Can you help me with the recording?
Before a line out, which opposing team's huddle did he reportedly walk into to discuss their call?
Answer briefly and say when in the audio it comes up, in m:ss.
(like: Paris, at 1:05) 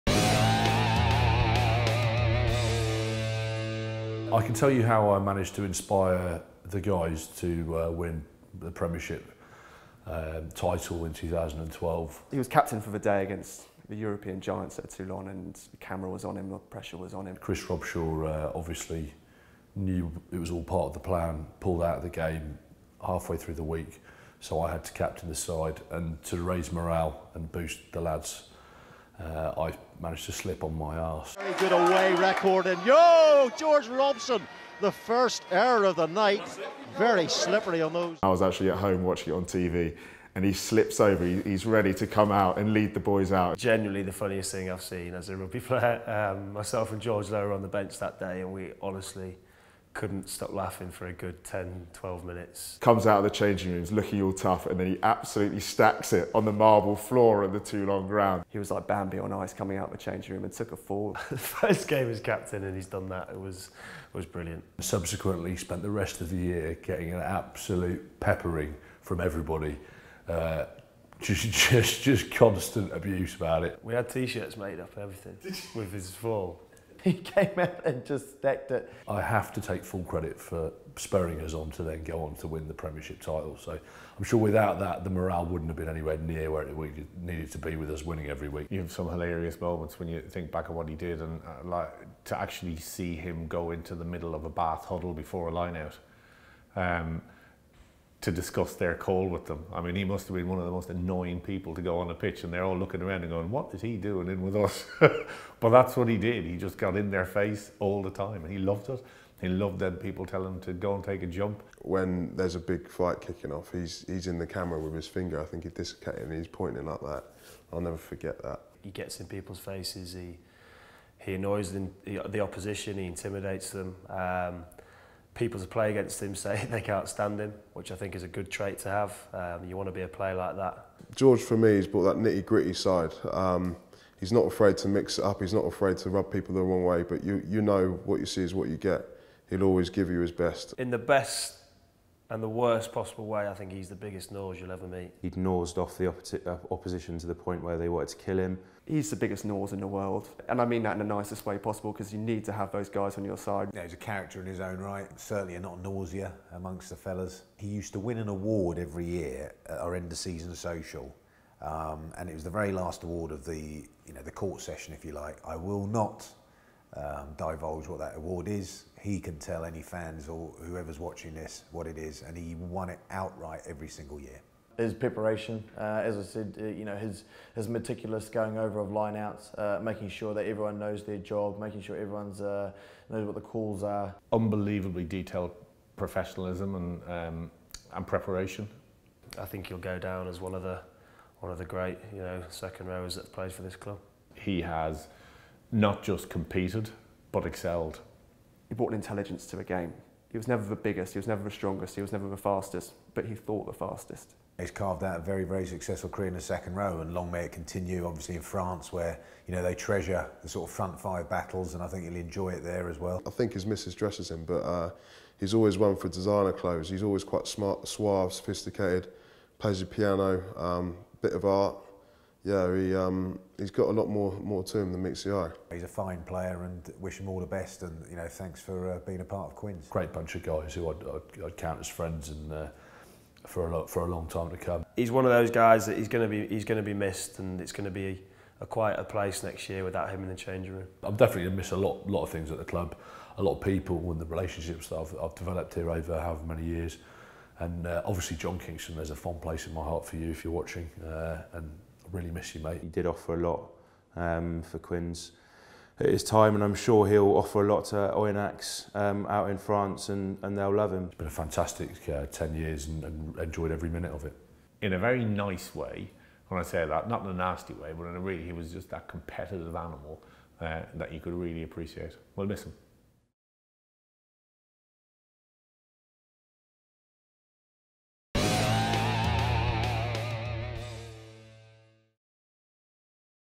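Bath, at 1:34.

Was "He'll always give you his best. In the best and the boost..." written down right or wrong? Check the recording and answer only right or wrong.
wrong.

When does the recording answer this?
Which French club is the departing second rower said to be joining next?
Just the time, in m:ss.
4:18.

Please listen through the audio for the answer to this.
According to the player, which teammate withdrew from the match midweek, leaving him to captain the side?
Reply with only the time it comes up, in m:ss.
0:17.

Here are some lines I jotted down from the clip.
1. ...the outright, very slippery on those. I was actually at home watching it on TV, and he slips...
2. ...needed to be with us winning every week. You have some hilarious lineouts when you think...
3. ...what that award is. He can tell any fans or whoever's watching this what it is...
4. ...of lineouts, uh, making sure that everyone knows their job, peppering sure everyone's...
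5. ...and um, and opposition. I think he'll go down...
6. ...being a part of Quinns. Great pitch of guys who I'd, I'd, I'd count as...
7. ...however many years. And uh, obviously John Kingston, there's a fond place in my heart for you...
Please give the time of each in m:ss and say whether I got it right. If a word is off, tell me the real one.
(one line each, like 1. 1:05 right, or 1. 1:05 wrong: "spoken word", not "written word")
1. 0:35 wrong: "night", not "outright"
2. 1:27 wrong: "moments", not "lineouts"
3. 2:47 right
4. 2:58 wrong: "making", not "peppering"
5. 3:06 wrong: "preparation", not "opposition"
6. 3:49 wrong: "bunch", not "pitch"
7. 4:06 right.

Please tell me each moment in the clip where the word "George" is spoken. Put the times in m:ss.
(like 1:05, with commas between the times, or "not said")
0:33, 0:47, 2:11.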